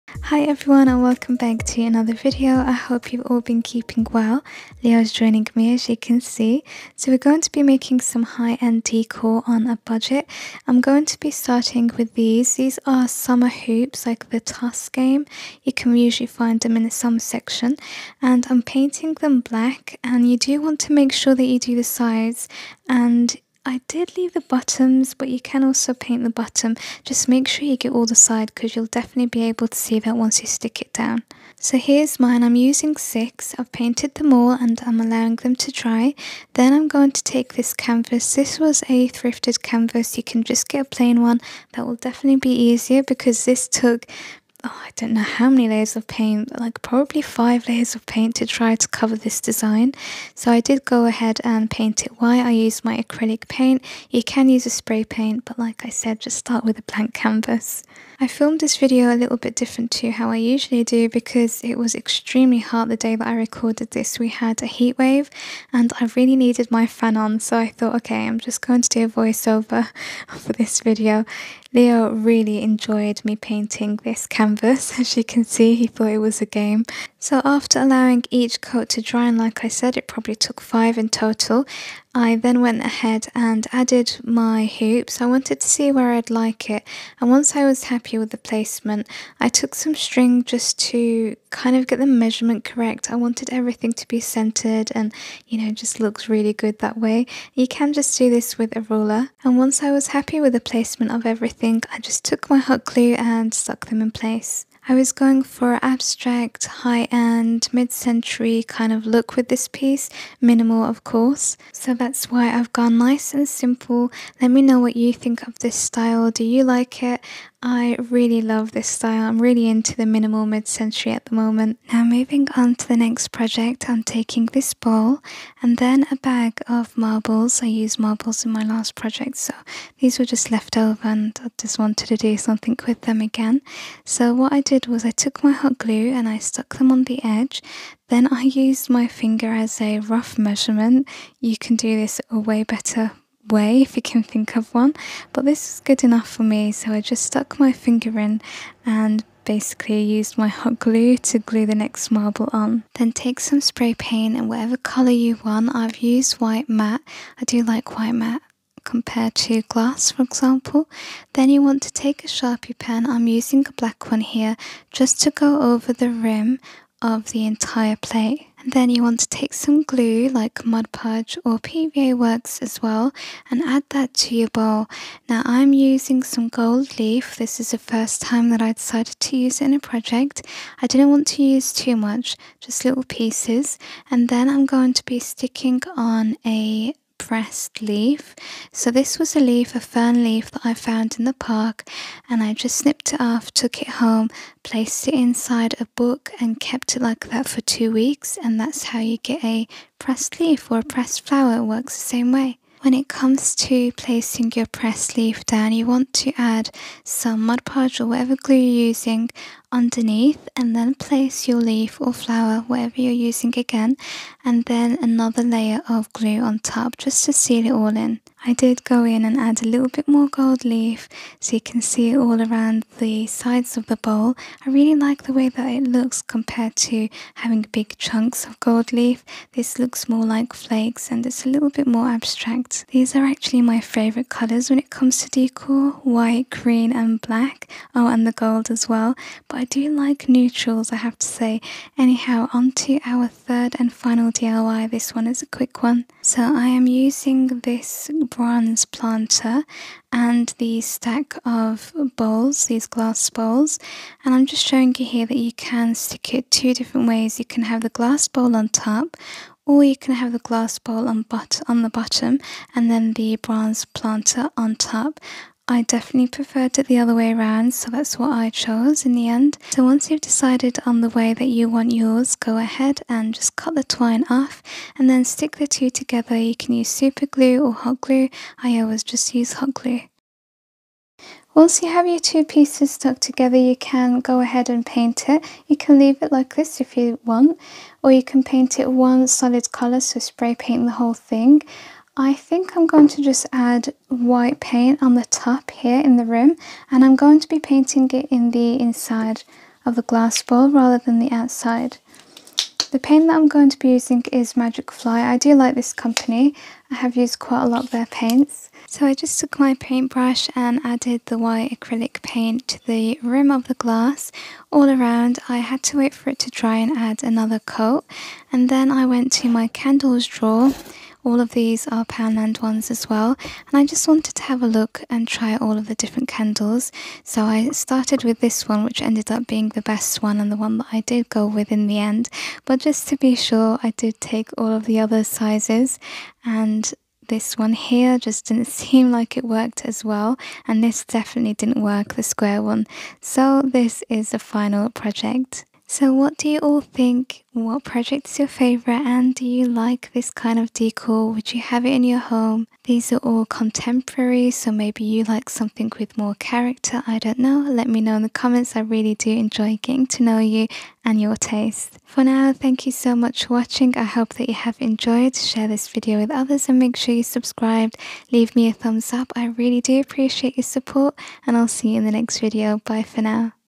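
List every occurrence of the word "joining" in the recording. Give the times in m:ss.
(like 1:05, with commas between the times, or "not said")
0:05.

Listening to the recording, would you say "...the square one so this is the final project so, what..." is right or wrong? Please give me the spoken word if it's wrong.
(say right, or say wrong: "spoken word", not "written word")
right.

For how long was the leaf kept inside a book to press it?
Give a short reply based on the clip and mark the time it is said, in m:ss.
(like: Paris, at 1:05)
2 weeks, at 3:17.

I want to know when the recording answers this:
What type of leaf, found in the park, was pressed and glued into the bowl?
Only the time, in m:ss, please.
3:09.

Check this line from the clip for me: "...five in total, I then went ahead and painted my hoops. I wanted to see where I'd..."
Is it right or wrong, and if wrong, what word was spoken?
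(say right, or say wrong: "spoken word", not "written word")
wrong: "added", not "painted".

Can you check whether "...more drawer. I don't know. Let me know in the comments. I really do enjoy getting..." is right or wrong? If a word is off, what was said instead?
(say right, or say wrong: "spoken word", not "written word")
wrong: "character", not "drawer".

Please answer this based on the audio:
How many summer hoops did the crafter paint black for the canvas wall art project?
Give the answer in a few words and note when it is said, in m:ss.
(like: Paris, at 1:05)
6, at 0:32.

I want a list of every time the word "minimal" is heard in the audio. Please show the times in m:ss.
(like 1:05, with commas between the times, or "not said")
1:50, 2:00.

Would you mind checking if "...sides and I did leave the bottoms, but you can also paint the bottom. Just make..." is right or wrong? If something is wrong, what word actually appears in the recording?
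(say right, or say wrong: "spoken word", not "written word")
right.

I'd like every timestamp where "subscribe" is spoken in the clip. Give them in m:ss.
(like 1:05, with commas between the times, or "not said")
6:07.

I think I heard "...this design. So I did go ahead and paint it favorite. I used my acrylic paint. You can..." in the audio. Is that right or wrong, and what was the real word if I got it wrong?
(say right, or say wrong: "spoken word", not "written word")
wrong: "white", not "favorite".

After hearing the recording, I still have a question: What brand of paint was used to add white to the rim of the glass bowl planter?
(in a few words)
Magic Fly.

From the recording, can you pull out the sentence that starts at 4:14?
And I'm just showing you here that you can stick it two different ways.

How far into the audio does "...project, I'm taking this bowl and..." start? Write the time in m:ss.
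2:03.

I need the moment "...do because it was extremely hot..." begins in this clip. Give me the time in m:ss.
1:00.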